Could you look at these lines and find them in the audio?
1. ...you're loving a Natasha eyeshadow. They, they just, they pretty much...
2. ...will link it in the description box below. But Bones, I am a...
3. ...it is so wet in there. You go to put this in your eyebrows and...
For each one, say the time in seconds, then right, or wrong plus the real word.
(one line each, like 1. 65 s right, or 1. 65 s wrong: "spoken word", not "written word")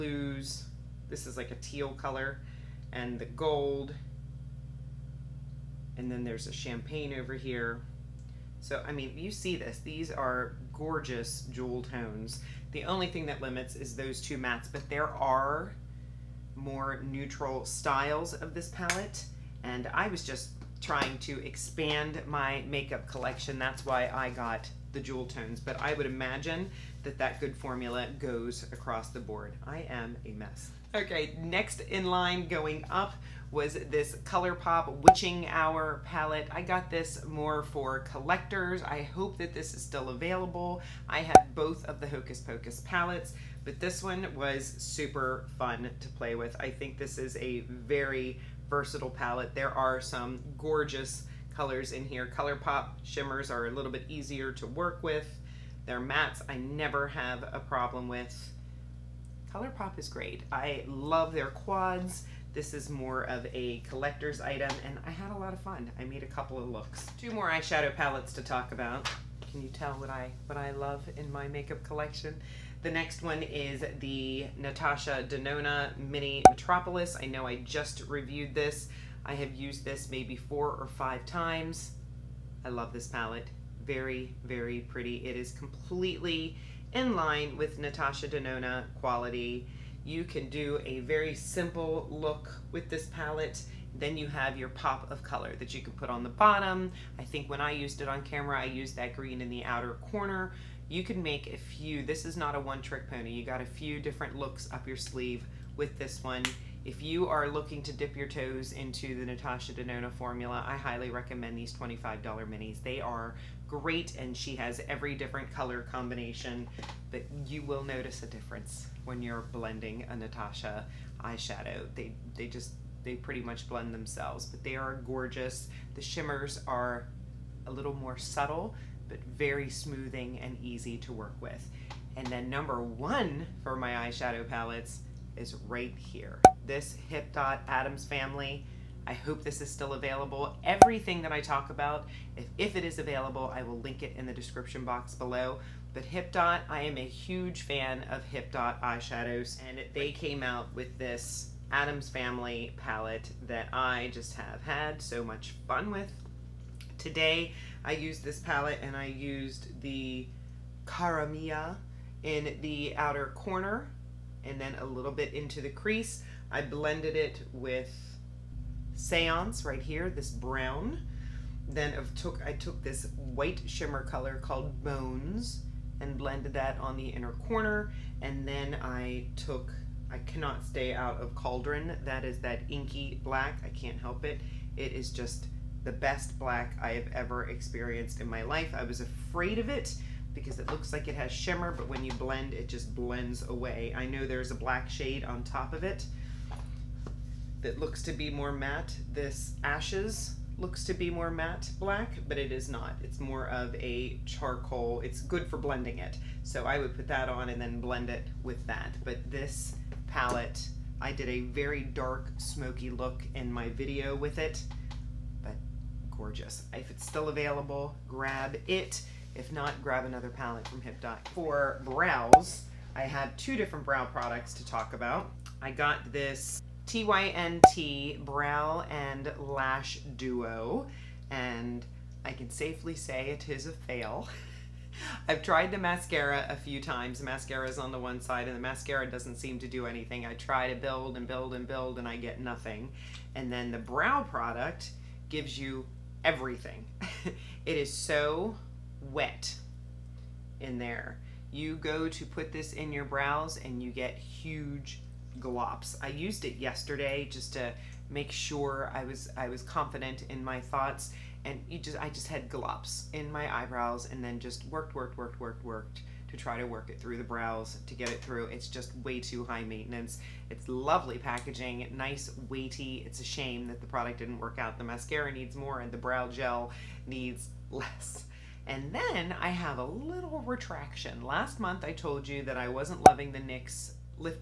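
1. 119 s wrong: "blending", not "loving"
2. 143 s wrong: "Hipdot", not "Bones"
3. 247 s wrong: "brows", not "eyebrows".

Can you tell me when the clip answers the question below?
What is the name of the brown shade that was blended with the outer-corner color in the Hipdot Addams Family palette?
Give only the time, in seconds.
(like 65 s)
168 s.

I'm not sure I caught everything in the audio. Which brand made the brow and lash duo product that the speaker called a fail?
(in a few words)
TYNT.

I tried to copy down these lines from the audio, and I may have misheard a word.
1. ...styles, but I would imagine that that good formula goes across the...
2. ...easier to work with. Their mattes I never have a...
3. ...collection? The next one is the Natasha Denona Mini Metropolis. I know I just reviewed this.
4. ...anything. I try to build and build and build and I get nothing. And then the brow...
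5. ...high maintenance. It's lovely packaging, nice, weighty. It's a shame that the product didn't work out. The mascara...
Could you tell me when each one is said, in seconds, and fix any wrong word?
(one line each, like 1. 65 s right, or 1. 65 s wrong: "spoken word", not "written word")
1. 25 s wrong: "tones", not "styles"
2. 54 s right
3. 71 s right
4. 239 s right
5. 269 s right.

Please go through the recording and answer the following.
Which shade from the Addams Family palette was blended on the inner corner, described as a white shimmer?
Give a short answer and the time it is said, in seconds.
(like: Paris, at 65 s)
Bones, at 174 s.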